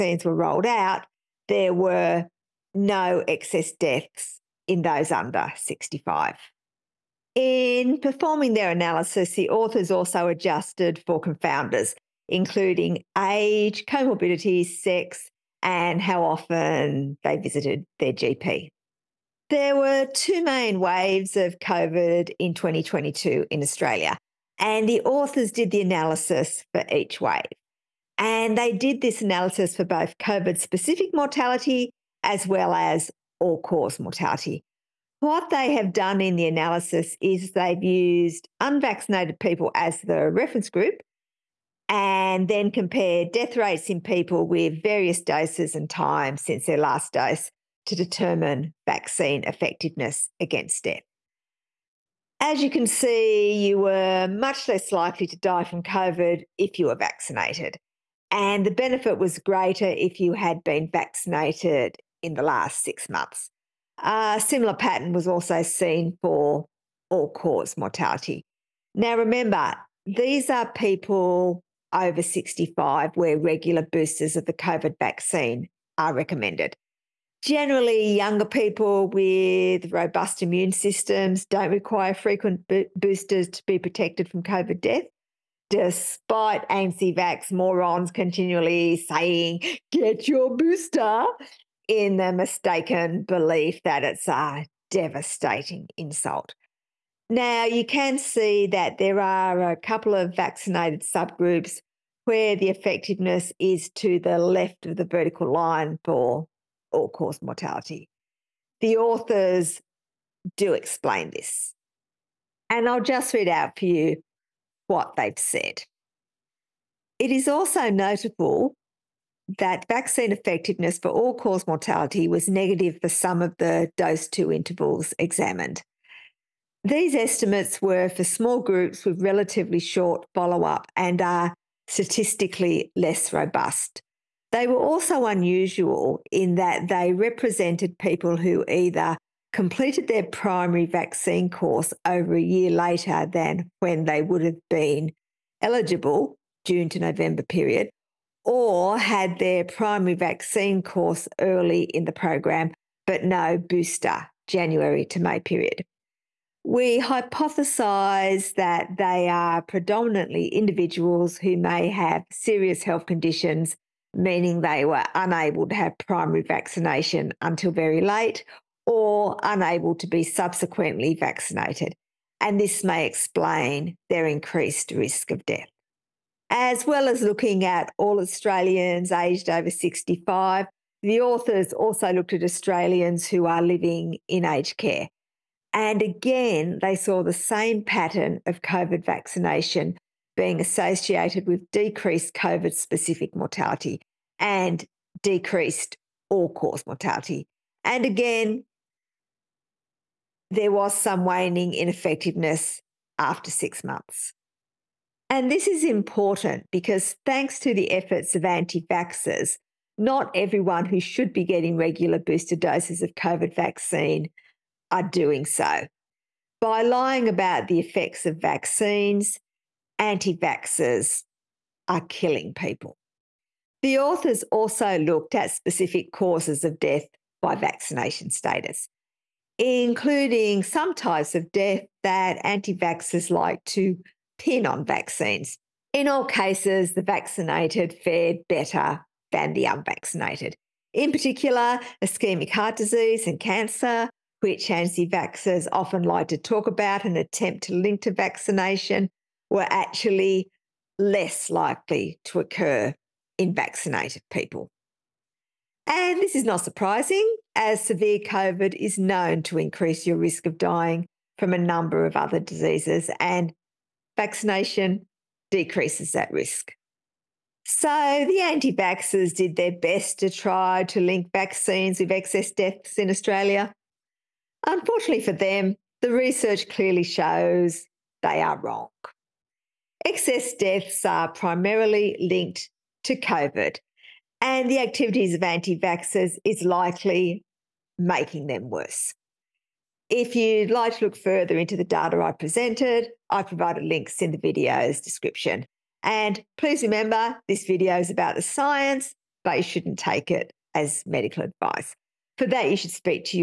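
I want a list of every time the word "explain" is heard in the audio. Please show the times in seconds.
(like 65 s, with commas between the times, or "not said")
110 s, 173 s.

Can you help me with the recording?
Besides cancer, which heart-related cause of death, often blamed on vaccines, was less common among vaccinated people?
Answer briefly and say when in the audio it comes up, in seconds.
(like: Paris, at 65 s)
Ischemic heart disease, at 242 s.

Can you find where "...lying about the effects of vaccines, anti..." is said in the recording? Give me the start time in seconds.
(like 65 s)
216 s.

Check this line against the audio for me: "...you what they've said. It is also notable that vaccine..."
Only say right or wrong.
right.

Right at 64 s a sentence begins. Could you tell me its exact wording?
A similar pattern was also seen for all cause mortality.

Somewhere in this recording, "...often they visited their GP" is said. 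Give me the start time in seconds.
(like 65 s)
16 s.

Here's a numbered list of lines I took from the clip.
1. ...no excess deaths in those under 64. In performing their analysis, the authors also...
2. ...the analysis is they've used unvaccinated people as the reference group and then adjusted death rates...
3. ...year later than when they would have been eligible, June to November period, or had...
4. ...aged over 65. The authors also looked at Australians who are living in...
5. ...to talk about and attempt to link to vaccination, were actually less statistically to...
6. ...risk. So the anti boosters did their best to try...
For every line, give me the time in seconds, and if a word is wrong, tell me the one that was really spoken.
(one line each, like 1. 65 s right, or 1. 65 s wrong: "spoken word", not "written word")
1. 2 s wrong: "65", not "64"
2. 36 s wrong: "compared", not "adjusted"
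3. 142 s right
4. 179 s right
5. 246 s wrong: "likely", not "statistically"
6. 266 s wrong: "vaxxers", not "boosters".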